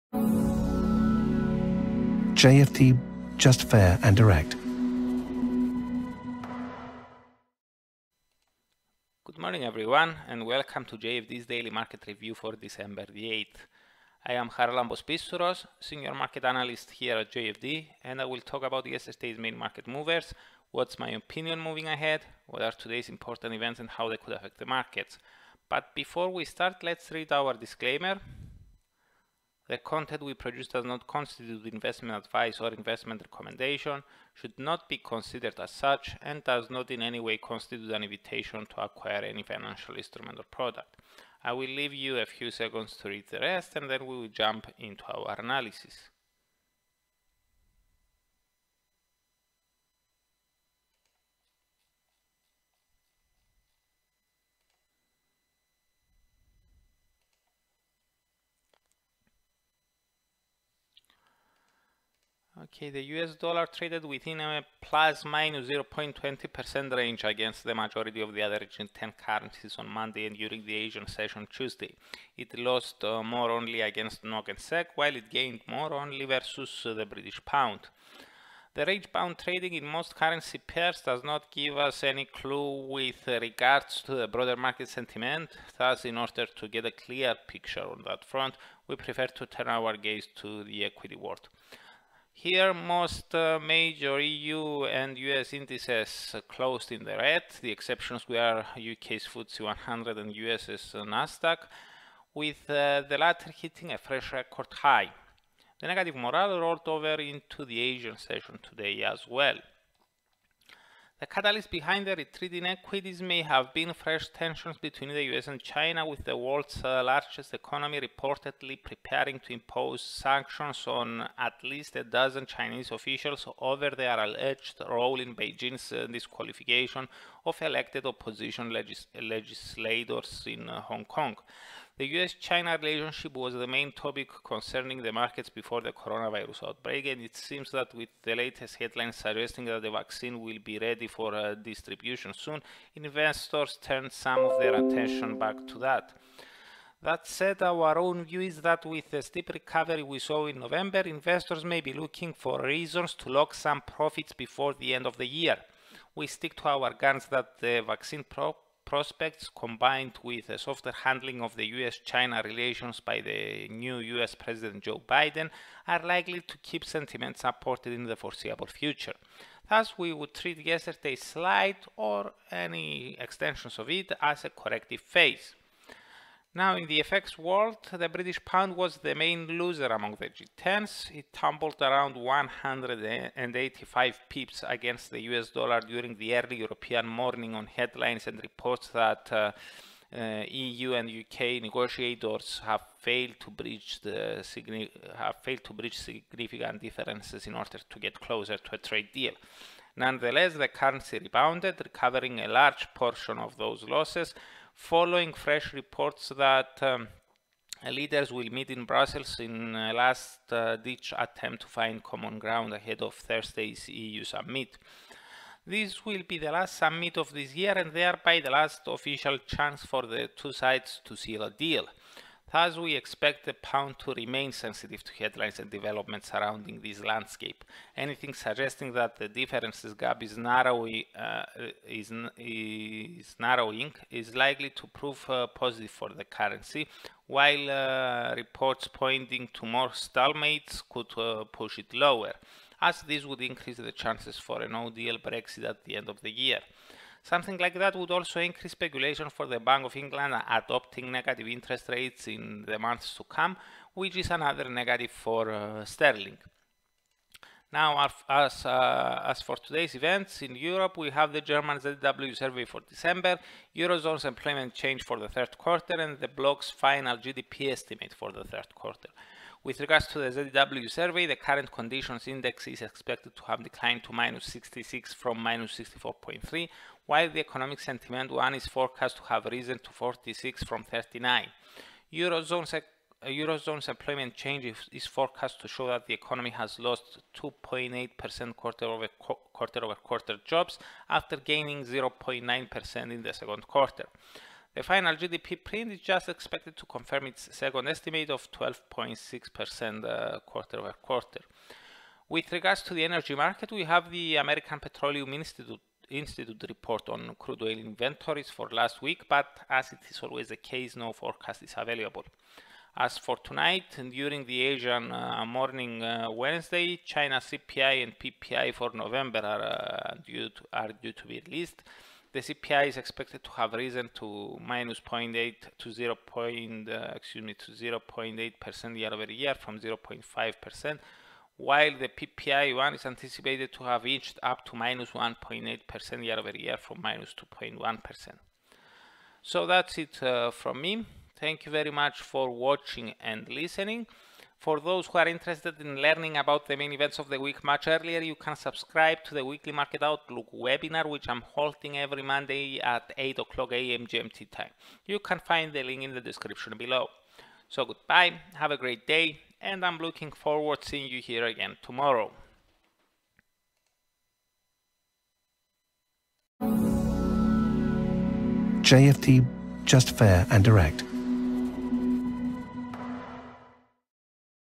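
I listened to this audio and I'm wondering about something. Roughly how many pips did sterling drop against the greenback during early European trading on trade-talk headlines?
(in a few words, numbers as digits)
185.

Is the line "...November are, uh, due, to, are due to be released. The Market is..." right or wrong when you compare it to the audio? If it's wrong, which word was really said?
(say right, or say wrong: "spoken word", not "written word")
wrong: "CPI", not "Market".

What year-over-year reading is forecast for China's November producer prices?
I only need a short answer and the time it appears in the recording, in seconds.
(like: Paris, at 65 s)
-1.8%, at 334 s.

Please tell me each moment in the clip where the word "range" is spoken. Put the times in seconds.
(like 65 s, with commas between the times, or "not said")
66 s, 78 s.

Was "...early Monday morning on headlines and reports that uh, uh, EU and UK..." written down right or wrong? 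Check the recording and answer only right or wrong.
wrong.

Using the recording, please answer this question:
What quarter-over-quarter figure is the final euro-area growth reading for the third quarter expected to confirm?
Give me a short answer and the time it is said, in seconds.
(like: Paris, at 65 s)
12.6%, at 298 s.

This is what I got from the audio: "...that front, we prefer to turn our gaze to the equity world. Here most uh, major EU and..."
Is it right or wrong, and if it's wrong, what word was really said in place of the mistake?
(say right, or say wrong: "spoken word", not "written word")
right.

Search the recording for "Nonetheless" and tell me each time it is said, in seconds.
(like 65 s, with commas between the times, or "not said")
199 s.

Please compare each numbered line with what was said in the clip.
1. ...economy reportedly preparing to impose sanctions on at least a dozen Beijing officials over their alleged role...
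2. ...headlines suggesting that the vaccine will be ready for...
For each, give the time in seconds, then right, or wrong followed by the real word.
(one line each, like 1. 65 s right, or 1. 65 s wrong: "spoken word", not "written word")
1. 117 s wrong: "Chinese", not "Beijing"
2. 138 s right.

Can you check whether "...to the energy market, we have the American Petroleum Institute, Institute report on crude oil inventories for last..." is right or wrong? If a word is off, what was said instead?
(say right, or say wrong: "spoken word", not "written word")
right.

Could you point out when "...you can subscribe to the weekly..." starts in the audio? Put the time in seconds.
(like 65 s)
348 s.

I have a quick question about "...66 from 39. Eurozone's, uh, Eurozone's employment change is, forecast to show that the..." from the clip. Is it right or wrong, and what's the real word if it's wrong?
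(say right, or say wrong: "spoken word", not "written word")
wrong: "46", not "66".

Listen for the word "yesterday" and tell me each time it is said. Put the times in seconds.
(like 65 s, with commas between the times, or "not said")
18 s, 170 s.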